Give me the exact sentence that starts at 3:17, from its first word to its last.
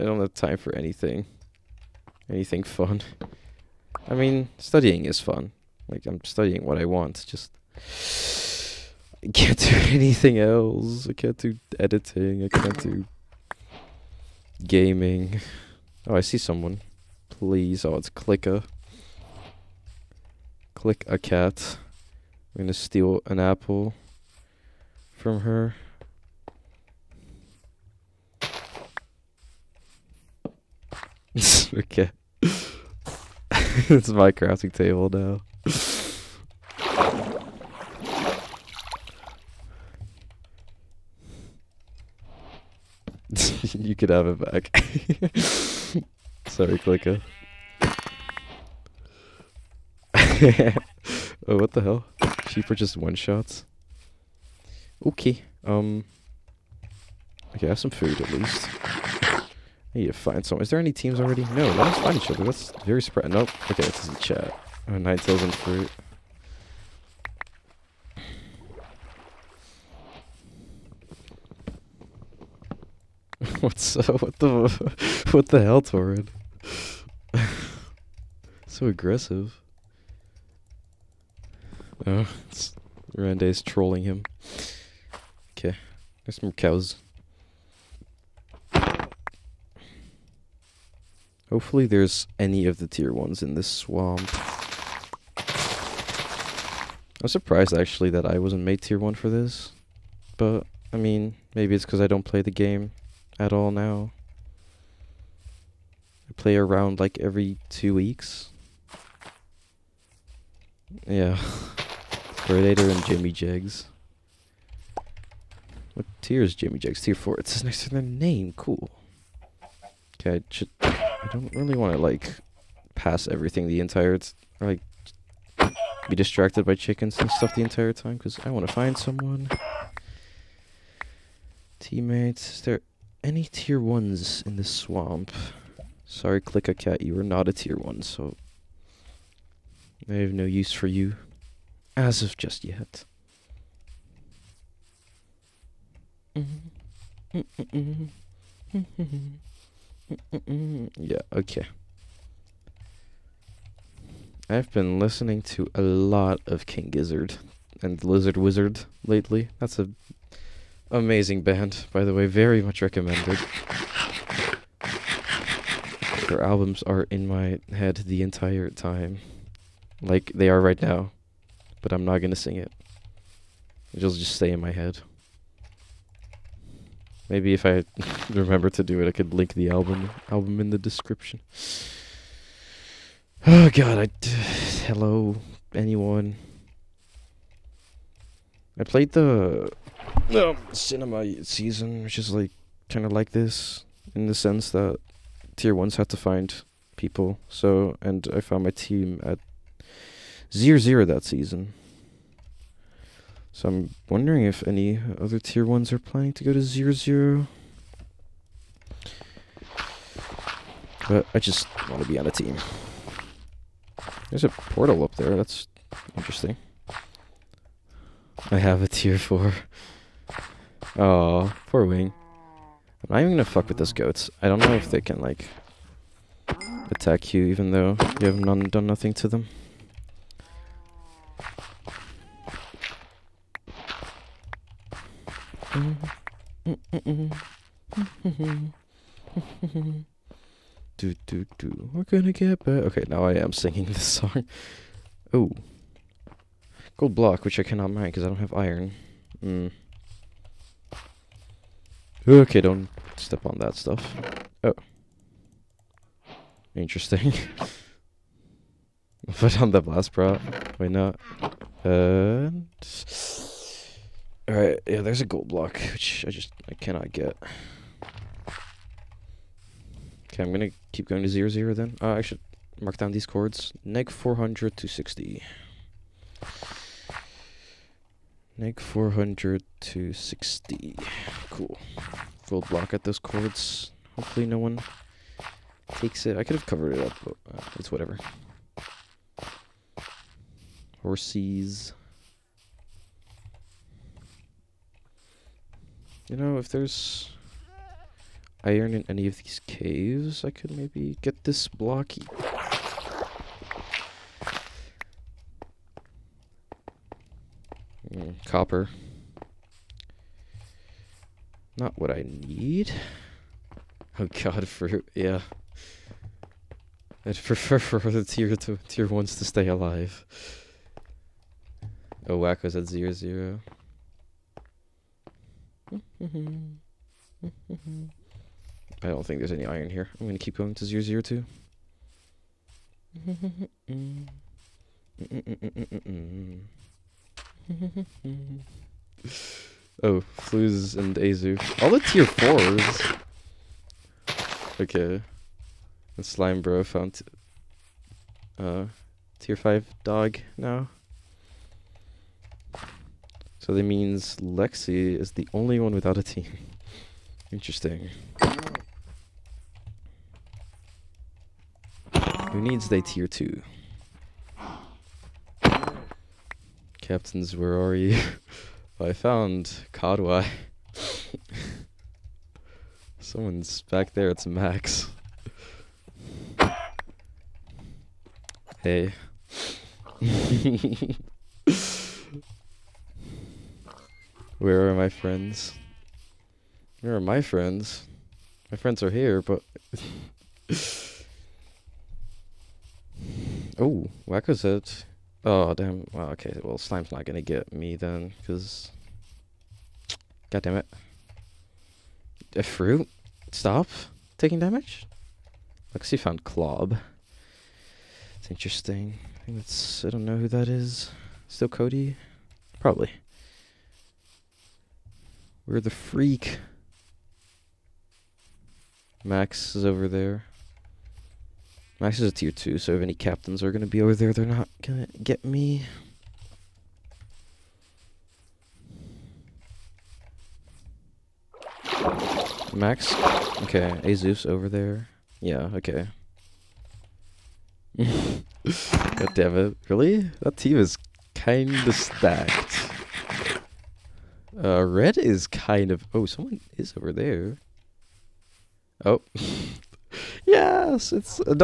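So and I found my team at Zero zero that season.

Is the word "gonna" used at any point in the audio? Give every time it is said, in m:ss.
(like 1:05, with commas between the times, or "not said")
0:22, 3:43, 4:02, 4:30, 5:30, 6:37.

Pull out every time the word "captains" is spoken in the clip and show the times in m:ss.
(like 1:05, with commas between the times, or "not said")
6:07, 7:03.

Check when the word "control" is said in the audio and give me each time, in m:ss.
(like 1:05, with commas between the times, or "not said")
not said.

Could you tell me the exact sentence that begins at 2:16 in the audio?
Sorry, Click a Cat, you are not a tier 1, so...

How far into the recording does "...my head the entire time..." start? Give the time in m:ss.
2:47.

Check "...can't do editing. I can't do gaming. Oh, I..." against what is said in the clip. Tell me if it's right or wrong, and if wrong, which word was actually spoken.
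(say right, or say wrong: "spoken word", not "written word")
right.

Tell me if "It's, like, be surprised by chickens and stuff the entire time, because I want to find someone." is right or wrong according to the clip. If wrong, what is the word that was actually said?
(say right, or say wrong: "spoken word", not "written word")
wrong: "distracted", not "surprised".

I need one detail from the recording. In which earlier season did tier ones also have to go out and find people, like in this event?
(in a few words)
cinema season.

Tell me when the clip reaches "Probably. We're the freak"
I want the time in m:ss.
6:52.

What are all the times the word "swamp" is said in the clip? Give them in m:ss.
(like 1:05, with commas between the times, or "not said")
1:33, 2:14.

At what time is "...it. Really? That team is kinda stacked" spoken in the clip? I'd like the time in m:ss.
7:19.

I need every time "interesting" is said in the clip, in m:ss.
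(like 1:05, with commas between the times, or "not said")
3:36, 4:16, 5:57, 6:48.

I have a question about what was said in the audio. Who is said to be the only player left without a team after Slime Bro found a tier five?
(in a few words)
Lexi.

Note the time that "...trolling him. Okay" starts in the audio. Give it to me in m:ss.
1:23.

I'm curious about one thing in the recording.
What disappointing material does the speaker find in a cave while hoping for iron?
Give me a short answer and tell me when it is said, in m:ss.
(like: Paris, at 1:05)
copper, at 5:08.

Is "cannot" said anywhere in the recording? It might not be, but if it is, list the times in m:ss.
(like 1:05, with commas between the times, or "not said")
4:07, 4:26.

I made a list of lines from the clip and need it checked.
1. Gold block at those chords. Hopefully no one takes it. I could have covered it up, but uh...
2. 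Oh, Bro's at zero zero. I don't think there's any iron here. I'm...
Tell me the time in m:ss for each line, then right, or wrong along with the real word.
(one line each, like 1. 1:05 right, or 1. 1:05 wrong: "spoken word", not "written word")
1. 4:42 right
2. 5:22 wrong: "Wacko", not "Bro".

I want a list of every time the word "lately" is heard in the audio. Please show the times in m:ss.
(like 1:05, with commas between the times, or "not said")
2:39.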